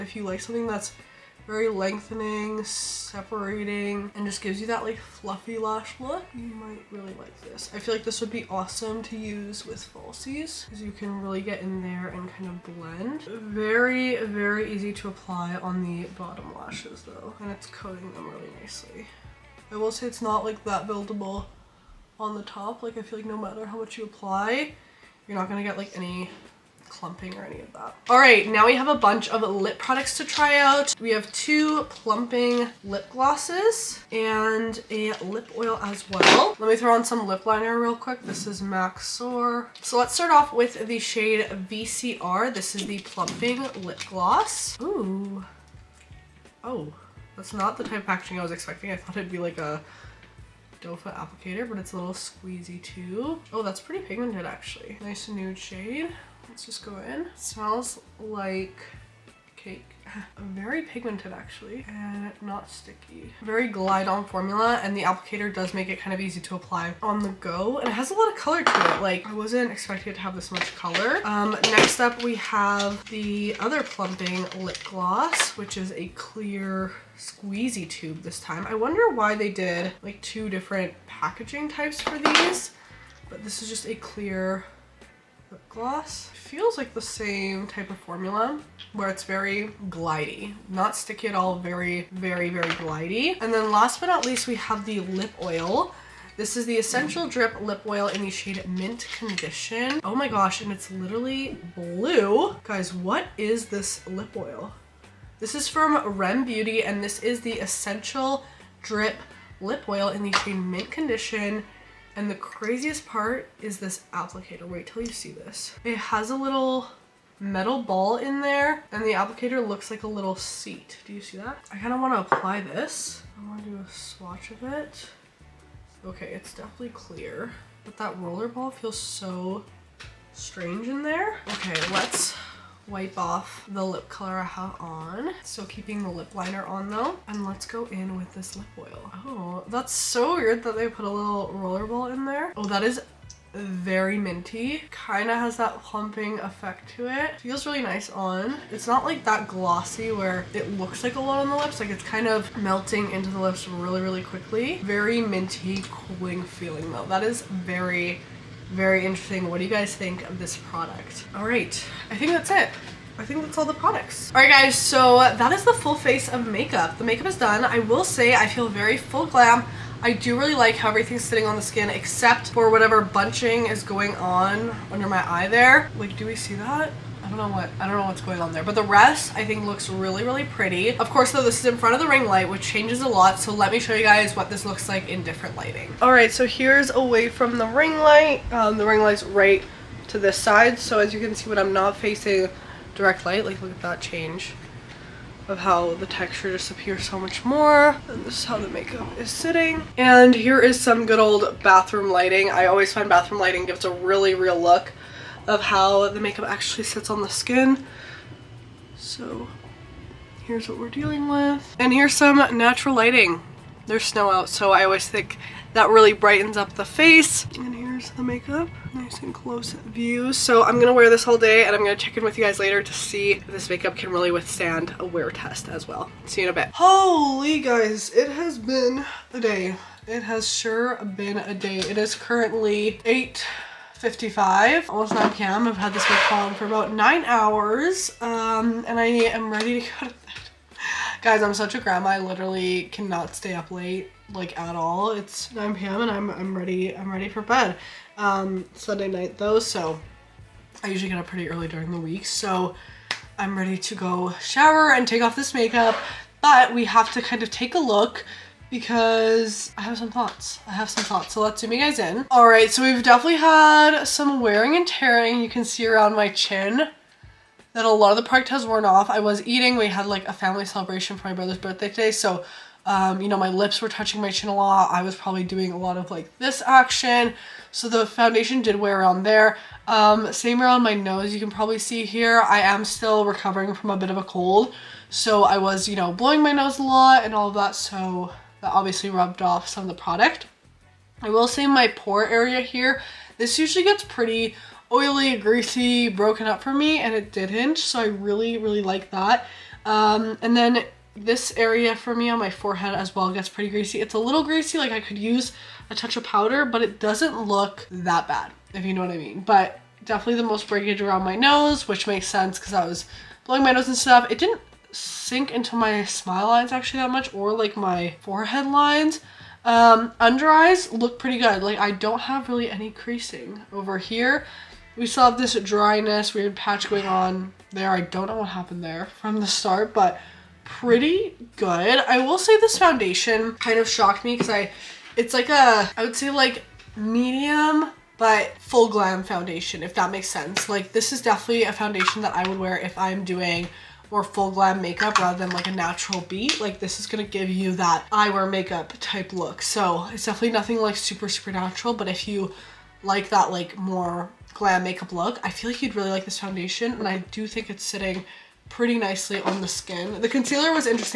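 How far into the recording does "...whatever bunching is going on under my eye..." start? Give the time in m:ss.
2:52.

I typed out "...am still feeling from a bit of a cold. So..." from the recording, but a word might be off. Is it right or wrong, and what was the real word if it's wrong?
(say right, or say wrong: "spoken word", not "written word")
wrong: "recovering", not "feeling".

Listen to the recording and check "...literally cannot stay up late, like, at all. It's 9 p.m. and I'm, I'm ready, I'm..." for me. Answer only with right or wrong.
right.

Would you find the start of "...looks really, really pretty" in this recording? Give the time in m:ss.
2:59.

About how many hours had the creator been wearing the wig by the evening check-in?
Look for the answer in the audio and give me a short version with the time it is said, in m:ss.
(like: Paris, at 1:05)
9, at 3:56.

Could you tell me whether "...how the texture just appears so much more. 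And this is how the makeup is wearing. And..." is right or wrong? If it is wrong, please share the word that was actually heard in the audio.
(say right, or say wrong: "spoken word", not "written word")
wrong: "sitting", not "wearing".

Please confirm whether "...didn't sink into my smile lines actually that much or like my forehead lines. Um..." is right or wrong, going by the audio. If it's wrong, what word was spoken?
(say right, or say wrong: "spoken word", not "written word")
right.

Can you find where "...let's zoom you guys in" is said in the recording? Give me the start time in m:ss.
4:21.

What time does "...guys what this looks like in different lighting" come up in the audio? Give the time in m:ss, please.
3:04.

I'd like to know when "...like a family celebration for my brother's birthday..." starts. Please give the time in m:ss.
4:30.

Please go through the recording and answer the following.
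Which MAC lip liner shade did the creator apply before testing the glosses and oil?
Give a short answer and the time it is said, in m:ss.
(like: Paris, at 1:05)
Soar, at 0:39.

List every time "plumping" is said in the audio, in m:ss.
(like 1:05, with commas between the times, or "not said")
0:31, 0:42, 1:13, 2:25.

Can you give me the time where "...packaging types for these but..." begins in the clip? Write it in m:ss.
1:21.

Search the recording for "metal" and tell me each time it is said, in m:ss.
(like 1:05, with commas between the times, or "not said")
1:57.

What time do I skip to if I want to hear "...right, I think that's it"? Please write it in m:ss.
2:41.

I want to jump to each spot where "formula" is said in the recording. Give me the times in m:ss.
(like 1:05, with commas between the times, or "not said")
1:04, 1:27.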